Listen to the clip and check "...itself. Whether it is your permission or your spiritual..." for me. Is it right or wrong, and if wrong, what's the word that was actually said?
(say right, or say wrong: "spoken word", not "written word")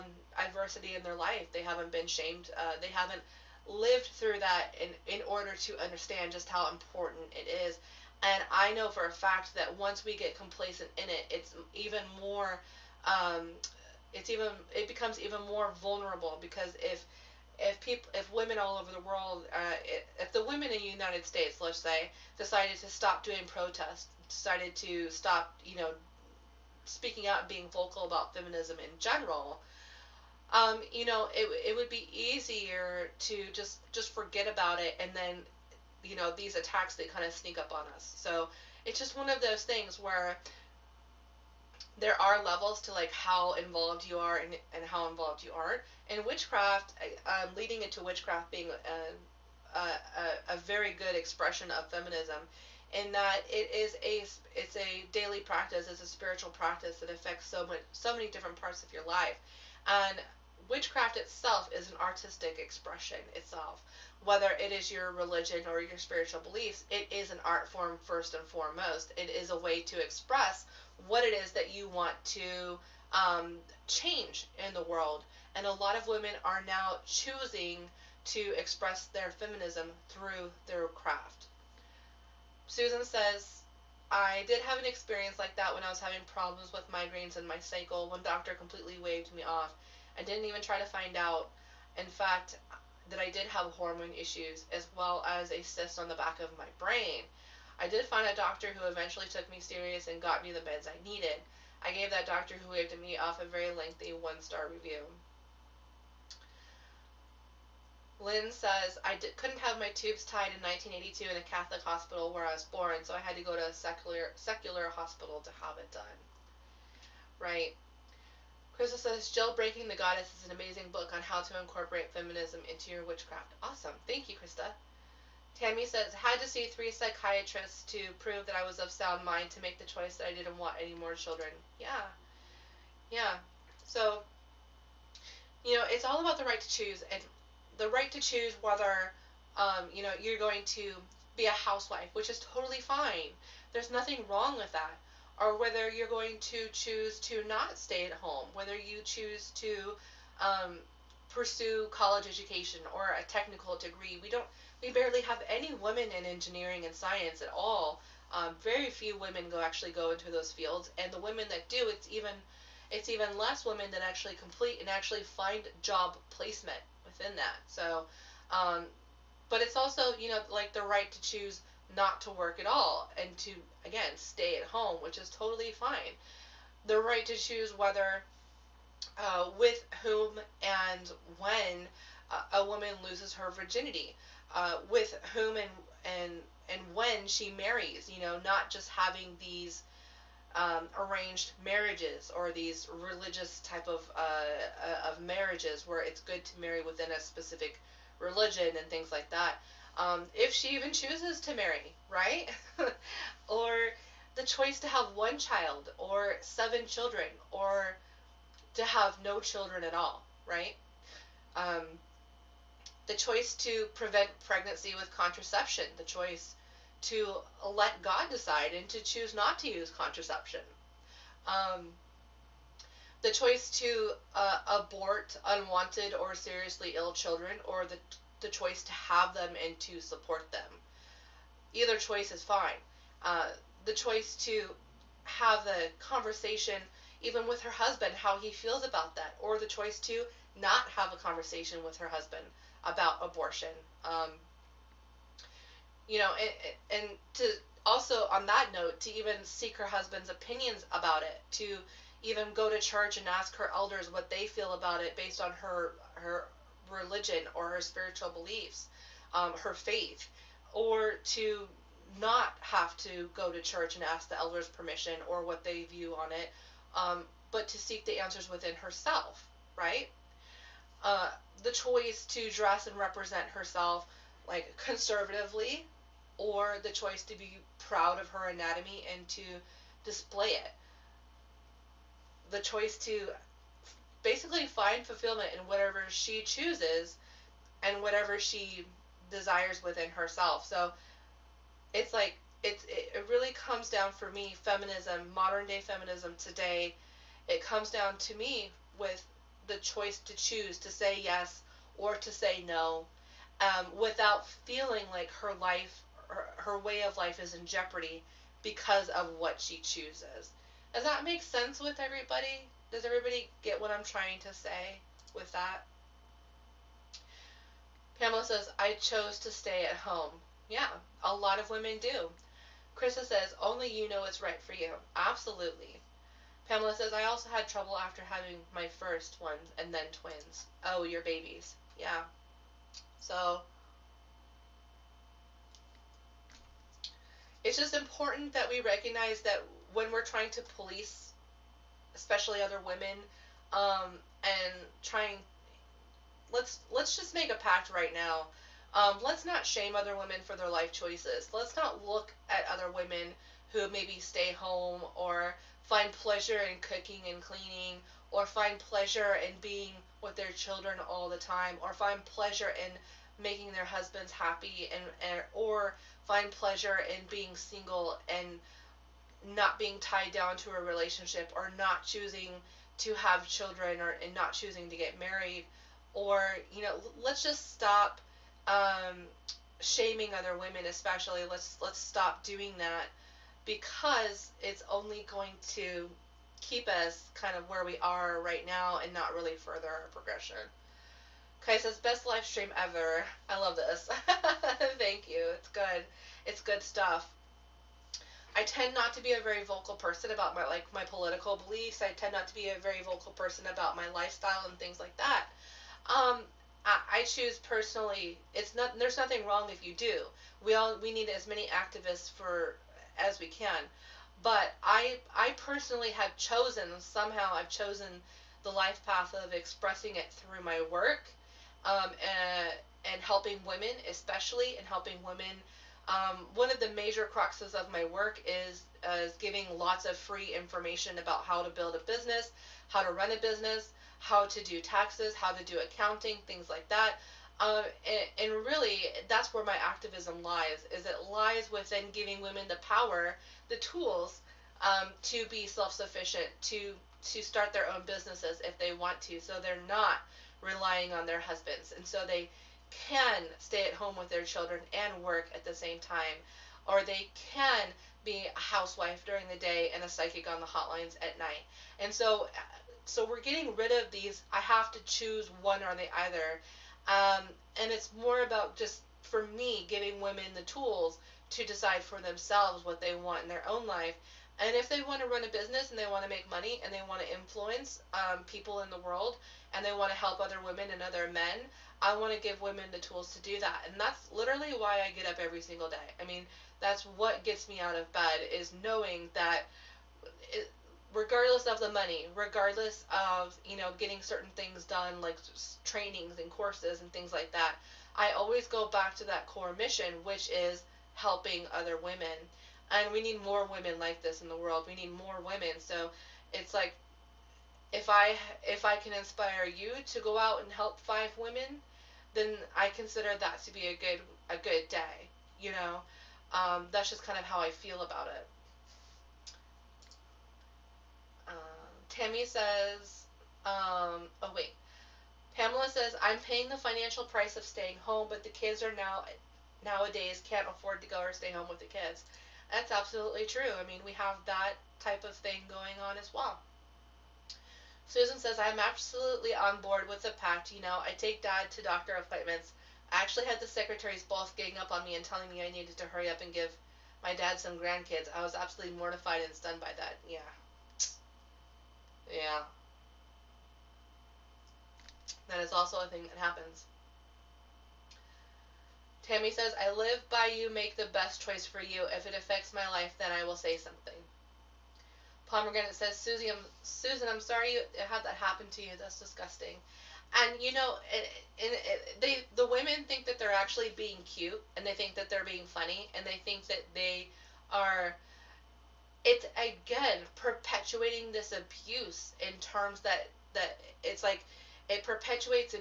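wrong: "religion", not "permission".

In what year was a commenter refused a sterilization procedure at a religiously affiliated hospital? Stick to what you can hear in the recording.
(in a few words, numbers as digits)
1982.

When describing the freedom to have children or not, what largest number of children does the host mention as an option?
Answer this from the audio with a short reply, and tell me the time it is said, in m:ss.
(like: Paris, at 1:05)
7, at 3:26.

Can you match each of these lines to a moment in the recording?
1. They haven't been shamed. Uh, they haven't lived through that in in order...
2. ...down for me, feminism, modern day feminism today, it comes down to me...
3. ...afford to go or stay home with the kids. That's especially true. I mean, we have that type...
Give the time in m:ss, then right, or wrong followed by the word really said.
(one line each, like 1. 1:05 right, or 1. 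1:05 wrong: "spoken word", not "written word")
1. 0:01 right
2. 4:53 right
3. 8:50 wrong: "absolutely", not "especially".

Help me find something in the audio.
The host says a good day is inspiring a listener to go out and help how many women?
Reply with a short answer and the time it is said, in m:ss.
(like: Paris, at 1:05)
5, at 8:31.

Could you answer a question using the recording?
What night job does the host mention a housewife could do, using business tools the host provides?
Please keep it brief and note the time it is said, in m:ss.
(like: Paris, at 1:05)
psychic on the hotlines, at 7:40.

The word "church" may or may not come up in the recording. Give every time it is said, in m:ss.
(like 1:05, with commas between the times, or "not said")
4:12, 4:23.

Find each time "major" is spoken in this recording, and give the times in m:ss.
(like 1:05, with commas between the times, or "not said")
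7:06.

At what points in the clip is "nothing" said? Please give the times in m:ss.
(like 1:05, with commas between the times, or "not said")
2:23, 6:49.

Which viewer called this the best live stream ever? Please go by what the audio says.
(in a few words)
Kai.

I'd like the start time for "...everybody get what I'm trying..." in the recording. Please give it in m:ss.
5:13.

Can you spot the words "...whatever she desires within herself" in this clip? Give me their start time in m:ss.
4:48.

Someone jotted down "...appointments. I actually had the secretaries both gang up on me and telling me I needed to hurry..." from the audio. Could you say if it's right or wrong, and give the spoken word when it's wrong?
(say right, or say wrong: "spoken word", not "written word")
right.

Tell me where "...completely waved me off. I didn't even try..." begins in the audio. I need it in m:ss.
1:28.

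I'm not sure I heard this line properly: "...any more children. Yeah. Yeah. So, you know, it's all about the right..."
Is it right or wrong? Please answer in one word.
right.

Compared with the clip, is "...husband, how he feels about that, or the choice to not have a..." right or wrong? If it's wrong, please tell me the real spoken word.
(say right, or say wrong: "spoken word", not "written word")
right.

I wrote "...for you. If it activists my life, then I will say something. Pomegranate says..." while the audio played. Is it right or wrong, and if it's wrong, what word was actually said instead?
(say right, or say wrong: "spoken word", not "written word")
wrong: "affects", not "activists".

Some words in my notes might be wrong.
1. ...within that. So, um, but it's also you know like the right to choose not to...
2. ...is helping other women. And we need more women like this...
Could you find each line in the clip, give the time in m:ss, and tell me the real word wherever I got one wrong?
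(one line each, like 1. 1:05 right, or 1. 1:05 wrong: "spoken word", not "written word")
1. 2:47 right
2. 8:20 right.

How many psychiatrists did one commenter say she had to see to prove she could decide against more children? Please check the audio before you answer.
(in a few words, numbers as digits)
3.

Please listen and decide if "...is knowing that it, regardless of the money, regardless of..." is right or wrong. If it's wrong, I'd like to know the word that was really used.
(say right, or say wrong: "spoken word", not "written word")
right.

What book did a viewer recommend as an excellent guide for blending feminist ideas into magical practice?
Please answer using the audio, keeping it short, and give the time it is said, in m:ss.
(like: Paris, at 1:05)
Jailbreaking the Goddess, at 1:59.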